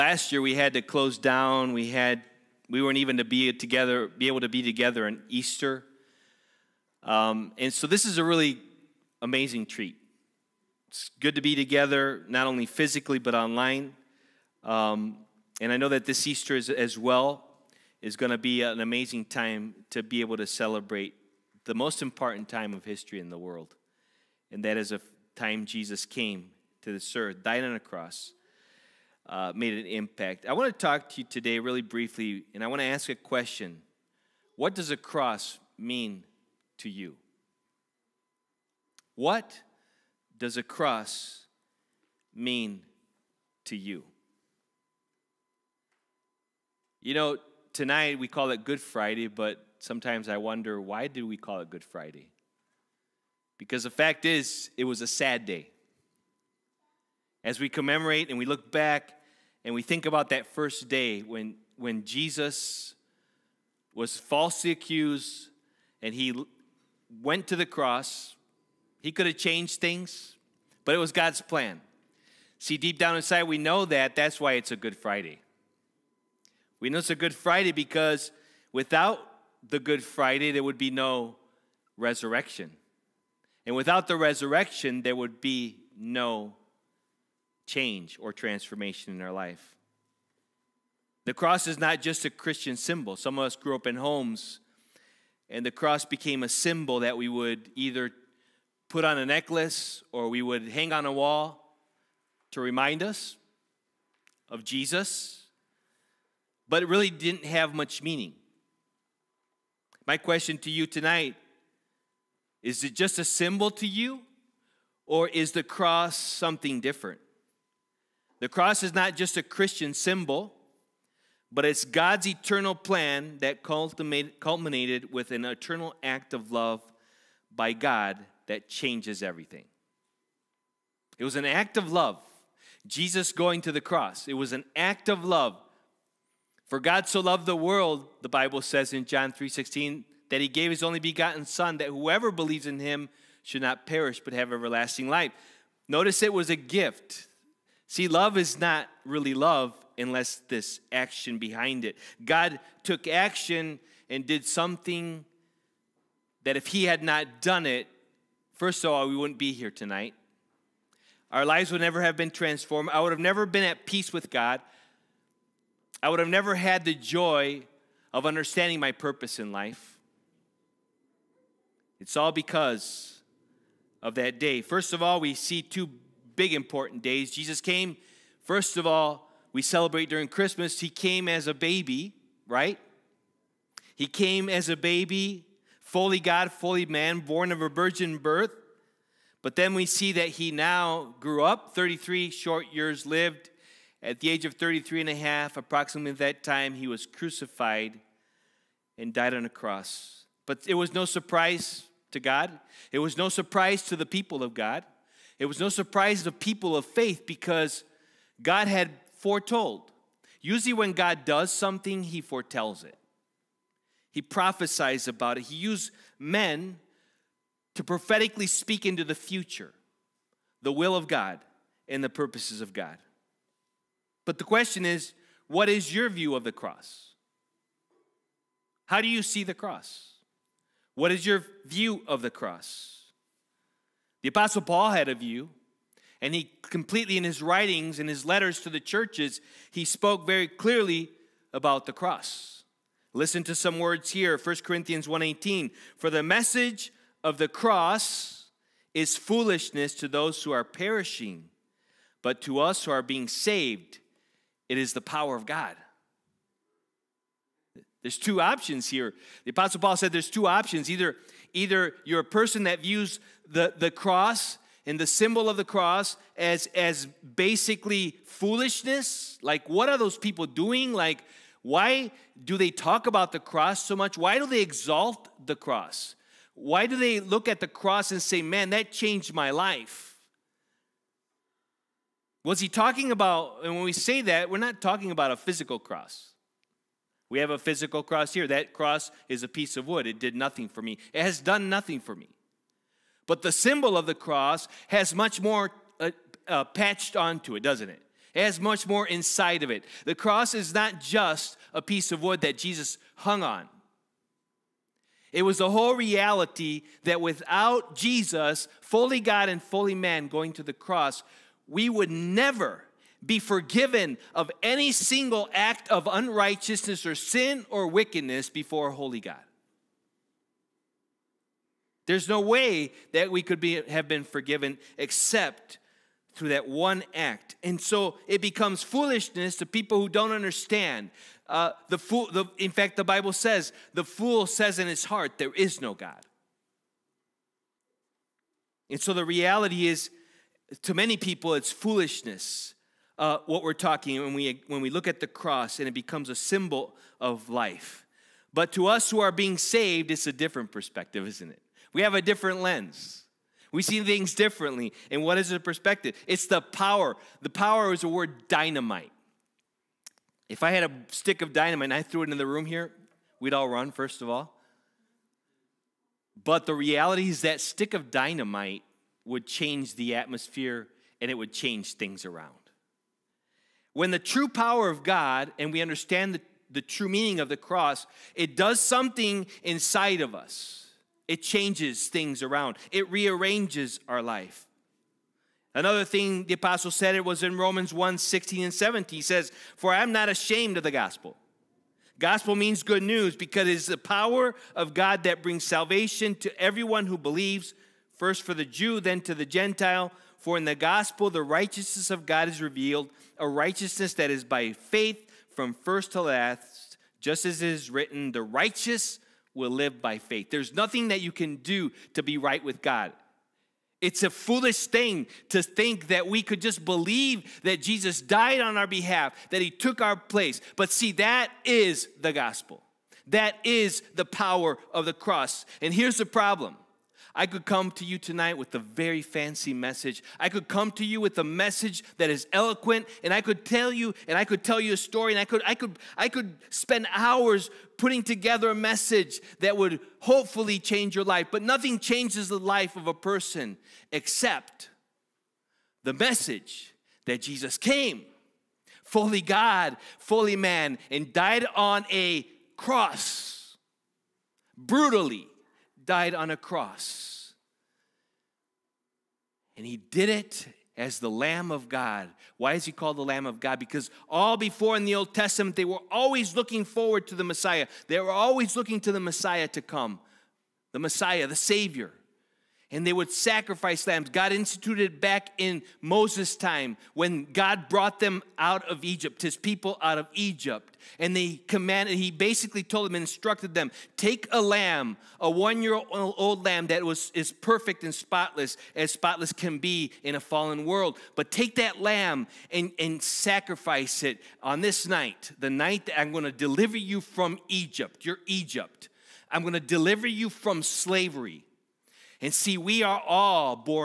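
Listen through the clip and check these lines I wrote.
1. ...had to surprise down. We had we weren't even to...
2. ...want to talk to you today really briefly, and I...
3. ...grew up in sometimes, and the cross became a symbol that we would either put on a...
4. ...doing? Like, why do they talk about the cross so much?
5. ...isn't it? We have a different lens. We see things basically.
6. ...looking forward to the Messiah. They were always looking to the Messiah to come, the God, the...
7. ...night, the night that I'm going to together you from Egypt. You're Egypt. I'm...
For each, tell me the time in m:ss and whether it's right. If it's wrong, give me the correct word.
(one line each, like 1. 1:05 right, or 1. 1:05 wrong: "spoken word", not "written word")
1. 0:00 wrong: "close", not "surprise"
2. 0:30 right
3. 1:33 wrong: "homes", not "sometimes"
4. 4:30 right
5. 5:51 wrong: "differently", not "basically"
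6. 7:46 wrong: "Messiah", not "God"
7. 8:15 wrong: "deliver", not "together".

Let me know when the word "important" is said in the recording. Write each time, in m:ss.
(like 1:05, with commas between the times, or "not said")
0:22, 2:56.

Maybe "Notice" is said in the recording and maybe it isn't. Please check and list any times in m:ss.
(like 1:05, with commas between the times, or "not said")
2:25.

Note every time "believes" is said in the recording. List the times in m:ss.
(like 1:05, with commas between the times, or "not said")
2:22, 6:37, 6:56.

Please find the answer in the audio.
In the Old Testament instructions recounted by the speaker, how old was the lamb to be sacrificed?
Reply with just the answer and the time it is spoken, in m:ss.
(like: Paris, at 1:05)
1 year old, at 8:05.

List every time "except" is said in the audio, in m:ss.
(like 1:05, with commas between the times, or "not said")
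5:24, 7:24.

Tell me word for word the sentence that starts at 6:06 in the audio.
But the reality is that stick of dynamite would change the atmosphere and it would change things around.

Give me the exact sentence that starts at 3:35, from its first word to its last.
He used men to prophetically speak into the future the will of God and the purposes of God.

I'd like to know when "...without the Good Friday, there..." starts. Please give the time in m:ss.
1:18.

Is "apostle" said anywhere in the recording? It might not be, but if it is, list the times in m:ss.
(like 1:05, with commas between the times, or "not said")
3:54, 4:19, 6:26.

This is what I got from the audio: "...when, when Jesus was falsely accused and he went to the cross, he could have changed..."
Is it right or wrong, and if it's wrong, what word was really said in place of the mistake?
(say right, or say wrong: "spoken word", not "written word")
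right.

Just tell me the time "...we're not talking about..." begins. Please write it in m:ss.
4:44.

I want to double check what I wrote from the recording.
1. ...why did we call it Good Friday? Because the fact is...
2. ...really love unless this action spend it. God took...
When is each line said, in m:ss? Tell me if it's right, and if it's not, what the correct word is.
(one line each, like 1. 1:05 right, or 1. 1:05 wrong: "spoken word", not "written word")
1. 0:50 right
2. 2:29 wrong: "behind", not "spend".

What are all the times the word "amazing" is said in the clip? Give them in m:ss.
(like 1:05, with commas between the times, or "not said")
0:09, 0:18.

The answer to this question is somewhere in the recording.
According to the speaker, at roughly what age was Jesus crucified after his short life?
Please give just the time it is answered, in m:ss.
3:14.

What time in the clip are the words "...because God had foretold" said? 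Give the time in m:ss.
3:27.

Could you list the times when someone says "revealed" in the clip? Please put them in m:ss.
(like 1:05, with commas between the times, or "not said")
6:42.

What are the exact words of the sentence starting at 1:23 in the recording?
And without the resurrection, there would be no change or transformation in our life.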